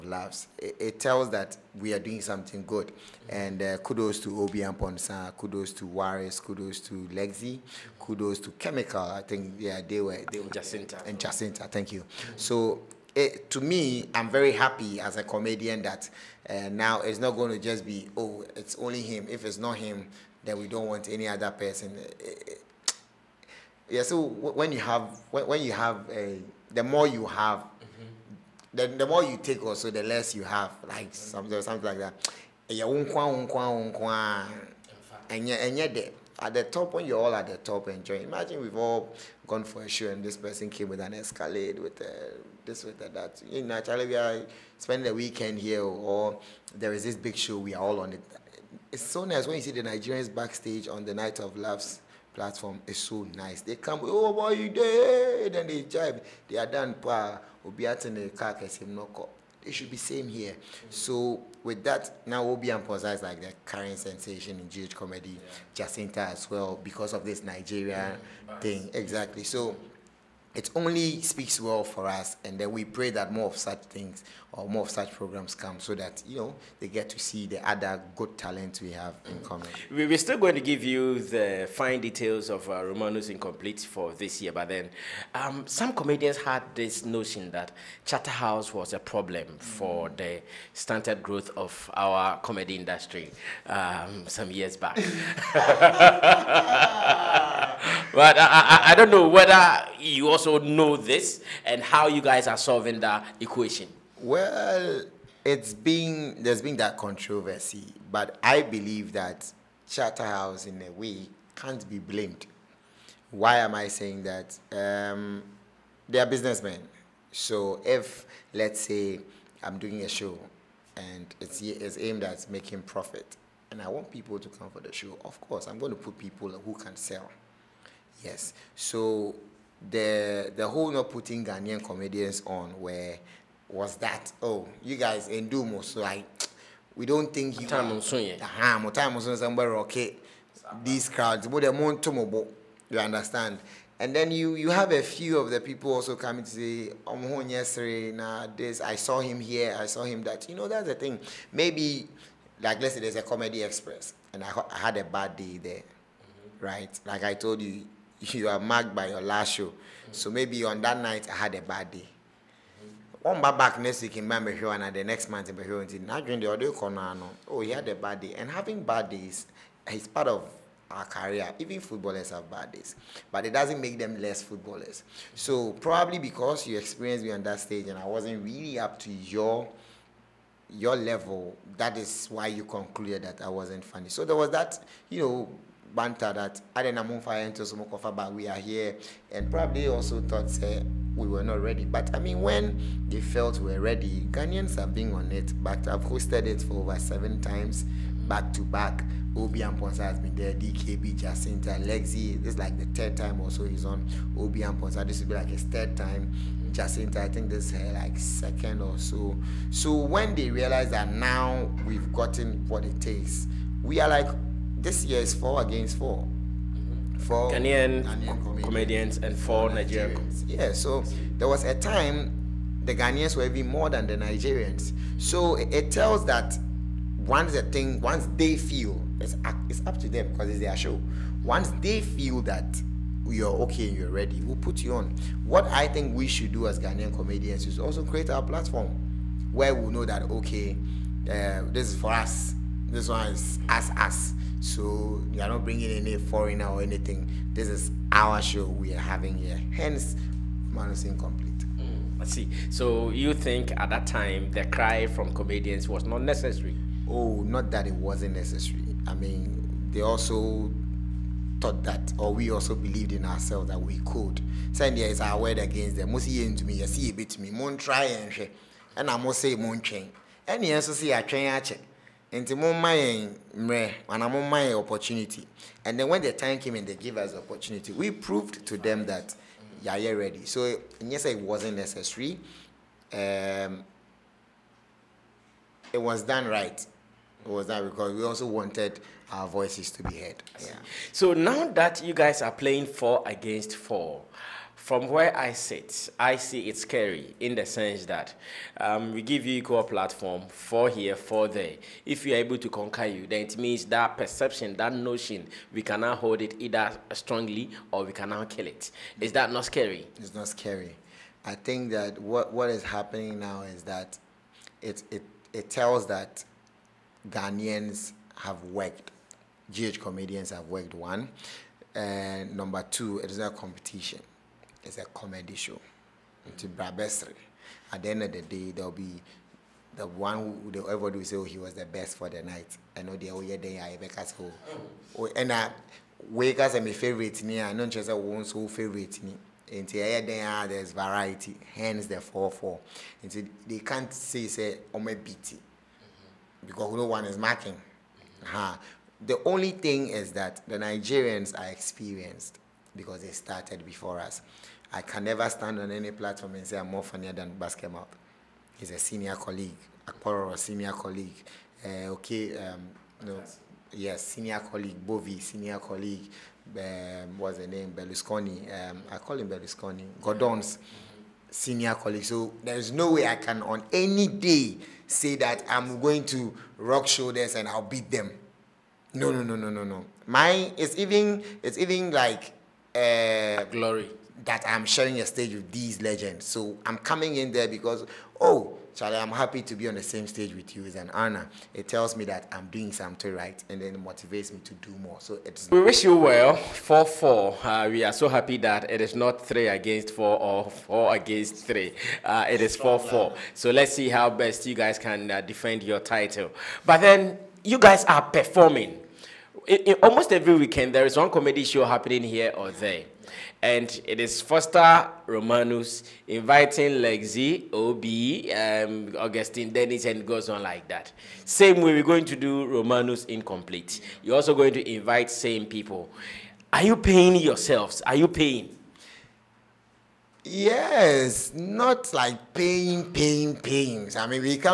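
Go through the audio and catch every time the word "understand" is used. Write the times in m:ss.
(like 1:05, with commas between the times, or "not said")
2:22.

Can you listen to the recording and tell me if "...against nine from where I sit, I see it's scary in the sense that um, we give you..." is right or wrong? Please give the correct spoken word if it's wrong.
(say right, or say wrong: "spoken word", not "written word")
wrong: "four", not "nine".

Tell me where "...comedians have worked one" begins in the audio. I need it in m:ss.
5:20.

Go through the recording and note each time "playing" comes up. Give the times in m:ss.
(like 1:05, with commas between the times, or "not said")
4:52.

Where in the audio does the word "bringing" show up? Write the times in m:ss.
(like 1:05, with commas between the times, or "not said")
4:05.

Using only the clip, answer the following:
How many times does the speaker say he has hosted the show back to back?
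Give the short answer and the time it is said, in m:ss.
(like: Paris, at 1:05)
over 7 times, at 3:16.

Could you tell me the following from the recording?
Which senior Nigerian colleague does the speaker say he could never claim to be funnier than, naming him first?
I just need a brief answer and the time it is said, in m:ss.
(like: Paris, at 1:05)
Basketmouth, at 5:57.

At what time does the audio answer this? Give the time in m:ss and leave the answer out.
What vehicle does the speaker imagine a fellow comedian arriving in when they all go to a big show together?
0:41.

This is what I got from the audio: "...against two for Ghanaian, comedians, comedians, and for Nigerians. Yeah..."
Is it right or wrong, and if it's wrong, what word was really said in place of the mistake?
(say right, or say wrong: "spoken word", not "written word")
wrong: "four", not "two".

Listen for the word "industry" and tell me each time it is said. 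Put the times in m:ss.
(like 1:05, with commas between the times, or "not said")
1:32.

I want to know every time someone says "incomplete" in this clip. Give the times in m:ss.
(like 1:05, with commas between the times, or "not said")
1:23, 4:11, 7:03.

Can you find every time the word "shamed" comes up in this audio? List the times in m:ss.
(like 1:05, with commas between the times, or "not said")
not said.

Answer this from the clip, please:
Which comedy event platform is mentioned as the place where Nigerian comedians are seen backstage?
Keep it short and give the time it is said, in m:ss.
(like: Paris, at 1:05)
Night of Laughs, at 0:51.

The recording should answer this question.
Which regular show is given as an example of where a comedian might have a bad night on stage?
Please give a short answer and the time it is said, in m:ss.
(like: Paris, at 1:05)
Comedy Express, at 2:33.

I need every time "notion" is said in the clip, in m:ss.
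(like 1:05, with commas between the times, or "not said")
1:27, 5:04.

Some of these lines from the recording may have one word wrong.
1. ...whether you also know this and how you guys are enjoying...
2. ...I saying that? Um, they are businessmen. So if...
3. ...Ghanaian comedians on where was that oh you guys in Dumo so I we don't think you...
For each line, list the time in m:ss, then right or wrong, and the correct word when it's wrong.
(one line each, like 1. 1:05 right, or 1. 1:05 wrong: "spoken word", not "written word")
1. 1:39 wrong: "solving", not "enjoying"
2. 1:53 right
3. 2:11 right.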